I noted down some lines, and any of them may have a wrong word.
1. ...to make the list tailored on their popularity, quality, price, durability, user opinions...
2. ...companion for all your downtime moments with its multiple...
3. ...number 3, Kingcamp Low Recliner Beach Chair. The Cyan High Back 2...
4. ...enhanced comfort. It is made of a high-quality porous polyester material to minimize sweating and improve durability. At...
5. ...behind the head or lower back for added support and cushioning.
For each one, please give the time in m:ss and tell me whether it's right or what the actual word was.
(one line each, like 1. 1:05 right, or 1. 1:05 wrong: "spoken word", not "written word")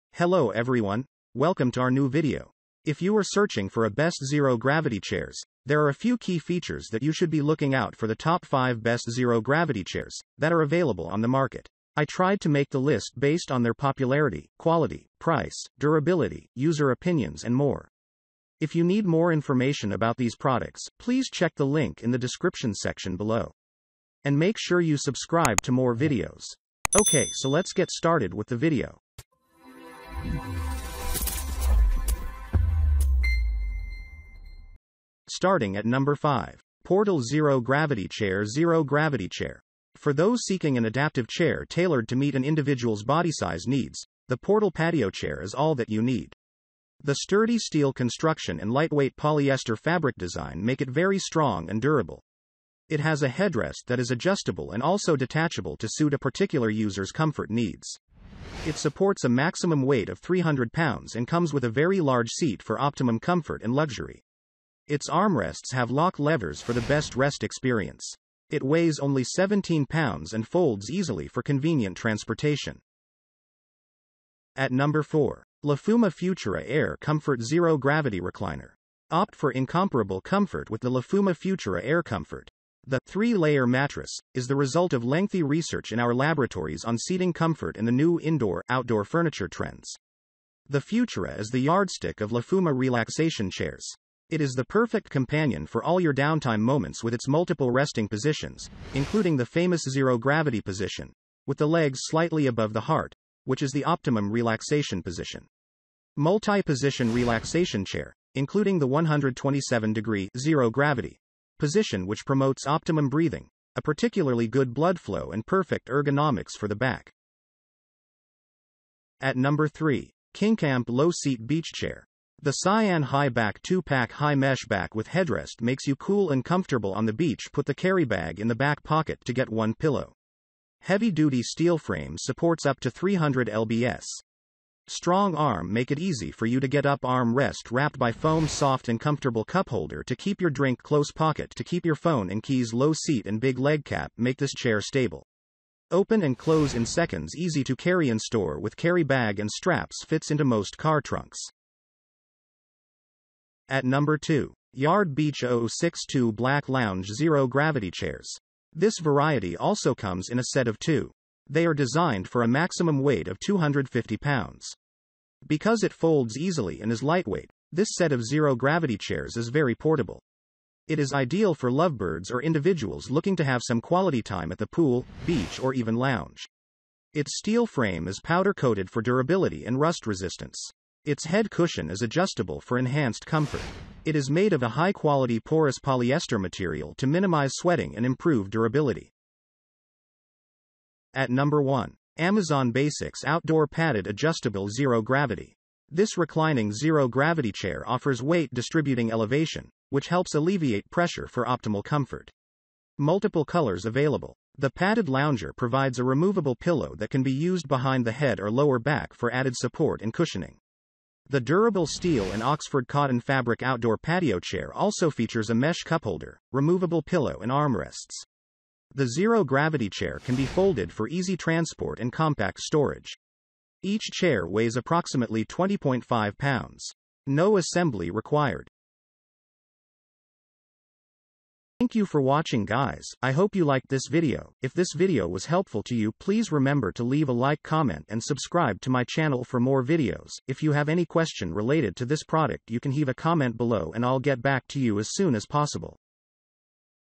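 1. 0:12 wrong: "based", not "tailored"
2. 1:35 right
3. 1:59 wrong: "Seat", not "Recliner"
4. 3:02 right
5. 3:27 right.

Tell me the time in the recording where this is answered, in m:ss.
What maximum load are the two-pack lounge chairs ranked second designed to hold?
2:43.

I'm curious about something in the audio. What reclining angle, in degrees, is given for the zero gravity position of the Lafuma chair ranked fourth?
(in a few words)
127 degrees.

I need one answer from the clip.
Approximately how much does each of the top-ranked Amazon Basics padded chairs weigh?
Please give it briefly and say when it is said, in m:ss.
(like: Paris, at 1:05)
20.5 pounds, at 3:45.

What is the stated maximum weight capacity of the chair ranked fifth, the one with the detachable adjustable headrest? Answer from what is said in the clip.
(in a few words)
300 pounds.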